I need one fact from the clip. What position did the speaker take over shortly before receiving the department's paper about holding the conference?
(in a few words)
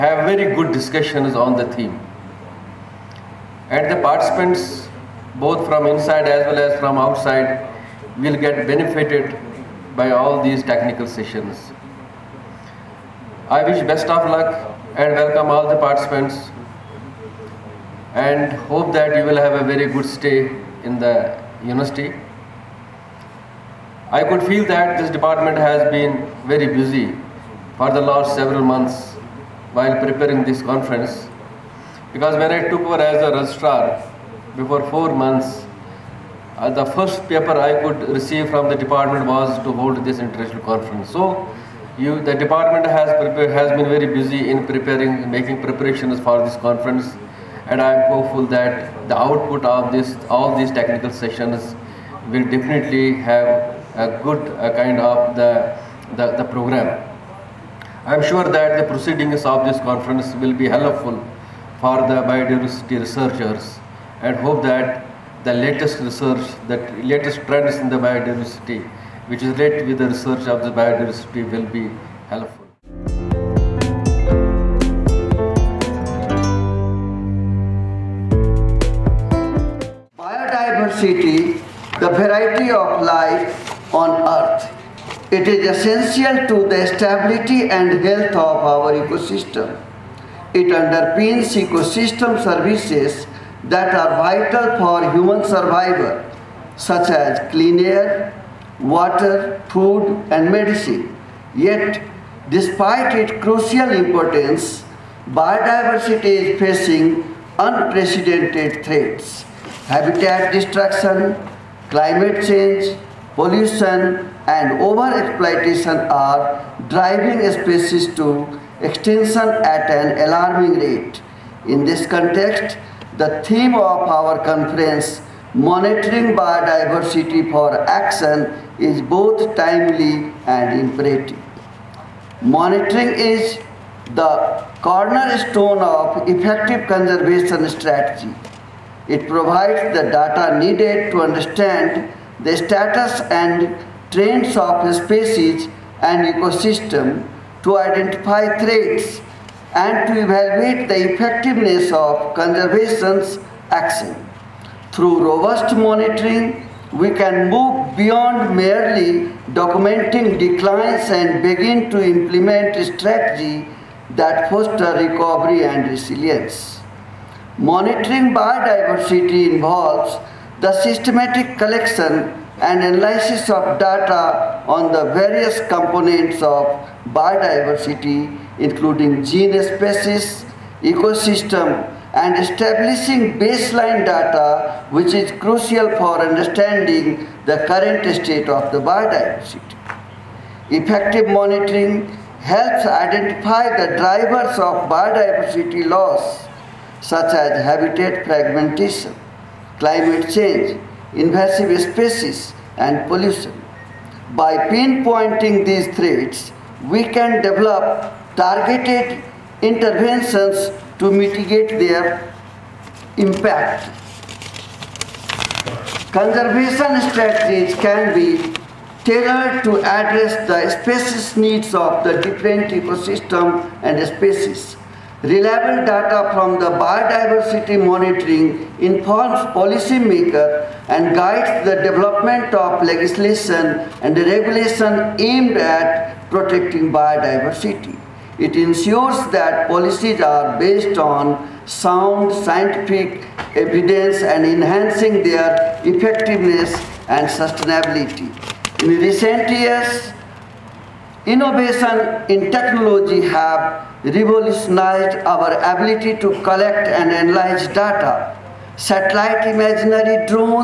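Registrar.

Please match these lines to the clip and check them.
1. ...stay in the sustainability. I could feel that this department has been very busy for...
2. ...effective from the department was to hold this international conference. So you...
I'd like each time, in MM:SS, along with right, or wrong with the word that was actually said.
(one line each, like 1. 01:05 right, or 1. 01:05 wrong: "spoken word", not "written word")
1. 00:20 wrong: "university", not "sustainability"
2. 00:38 wrong: "receive", not "effective".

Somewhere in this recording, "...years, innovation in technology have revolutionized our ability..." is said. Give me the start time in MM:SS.
04:09.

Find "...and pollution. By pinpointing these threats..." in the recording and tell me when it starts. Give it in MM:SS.
03:22.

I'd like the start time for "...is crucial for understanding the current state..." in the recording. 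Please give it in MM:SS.
03:05.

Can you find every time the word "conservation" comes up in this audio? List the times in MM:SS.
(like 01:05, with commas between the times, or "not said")
02:16, 02:32, 03:36.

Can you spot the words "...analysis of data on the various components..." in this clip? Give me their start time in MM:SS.
02:52.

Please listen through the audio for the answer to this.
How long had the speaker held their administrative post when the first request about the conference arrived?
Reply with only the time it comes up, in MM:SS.
00:34.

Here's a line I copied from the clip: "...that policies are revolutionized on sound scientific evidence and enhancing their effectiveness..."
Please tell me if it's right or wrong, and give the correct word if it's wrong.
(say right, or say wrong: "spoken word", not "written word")
wrong: "based", not "revolutionized".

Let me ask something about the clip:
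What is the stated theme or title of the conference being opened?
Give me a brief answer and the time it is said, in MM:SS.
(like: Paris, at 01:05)
Monitoring Biodiversity for Action, at 02:05.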